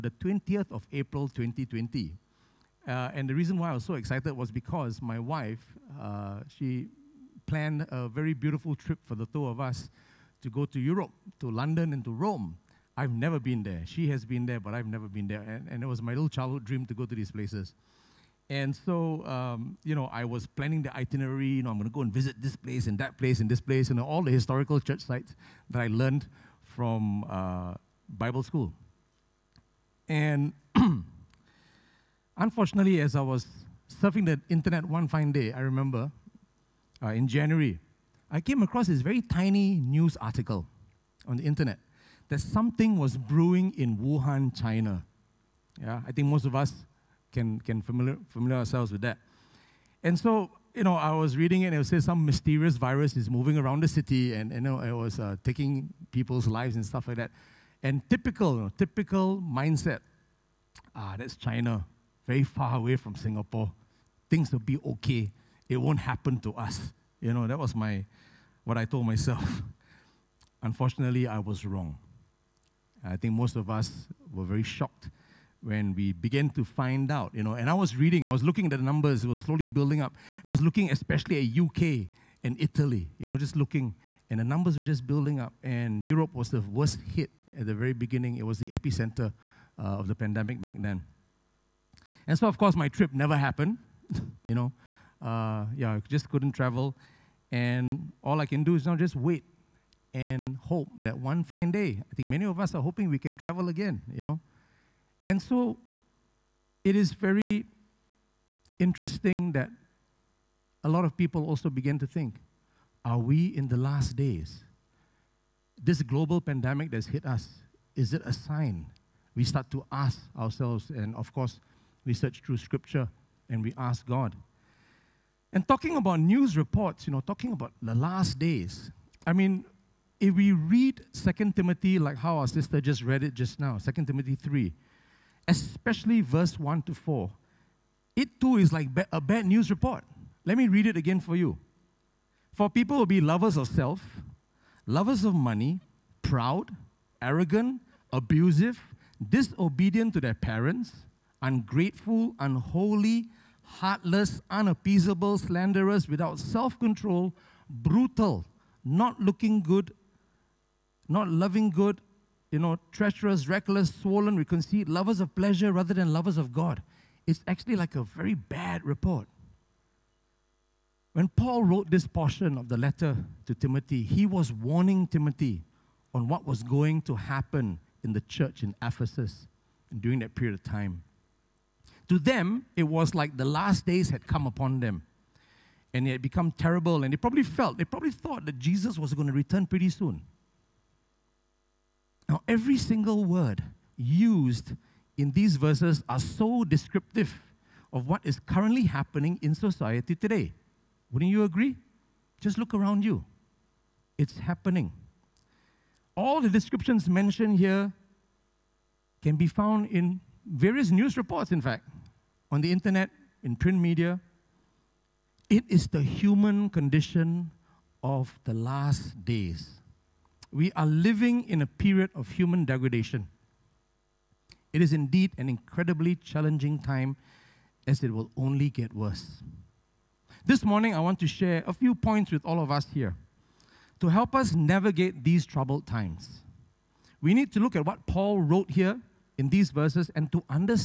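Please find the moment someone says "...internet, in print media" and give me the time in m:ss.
3:32.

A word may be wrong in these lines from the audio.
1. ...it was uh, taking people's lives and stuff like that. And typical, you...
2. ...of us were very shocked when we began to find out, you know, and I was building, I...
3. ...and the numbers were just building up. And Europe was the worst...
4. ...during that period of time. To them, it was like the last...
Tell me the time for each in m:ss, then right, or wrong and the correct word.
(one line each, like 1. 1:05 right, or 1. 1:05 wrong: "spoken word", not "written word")
1. 0:54 right
2. 1:13 wrong: "reading", not "building"
3. 1:24 right
4. 3:00 right.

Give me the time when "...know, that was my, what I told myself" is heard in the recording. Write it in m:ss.
1:07.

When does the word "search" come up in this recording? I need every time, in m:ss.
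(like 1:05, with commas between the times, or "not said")
2:02.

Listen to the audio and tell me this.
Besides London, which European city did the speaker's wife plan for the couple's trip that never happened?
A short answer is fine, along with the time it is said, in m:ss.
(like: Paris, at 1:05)
Rome, at 0:12.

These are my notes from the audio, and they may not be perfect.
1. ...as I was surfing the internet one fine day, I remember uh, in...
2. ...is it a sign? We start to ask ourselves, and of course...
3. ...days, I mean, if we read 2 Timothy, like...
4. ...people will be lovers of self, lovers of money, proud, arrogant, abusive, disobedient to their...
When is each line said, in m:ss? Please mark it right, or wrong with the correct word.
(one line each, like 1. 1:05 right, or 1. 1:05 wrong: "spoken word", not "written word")
1. 0:33 right
2. 1:57 right
3. 2:08 right
4. 2:22 right.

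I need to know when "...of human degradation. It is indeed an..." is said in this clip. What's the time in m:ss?
3:42.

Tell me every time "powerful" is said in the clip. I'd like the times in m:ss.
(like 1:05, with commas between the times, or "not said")
not said.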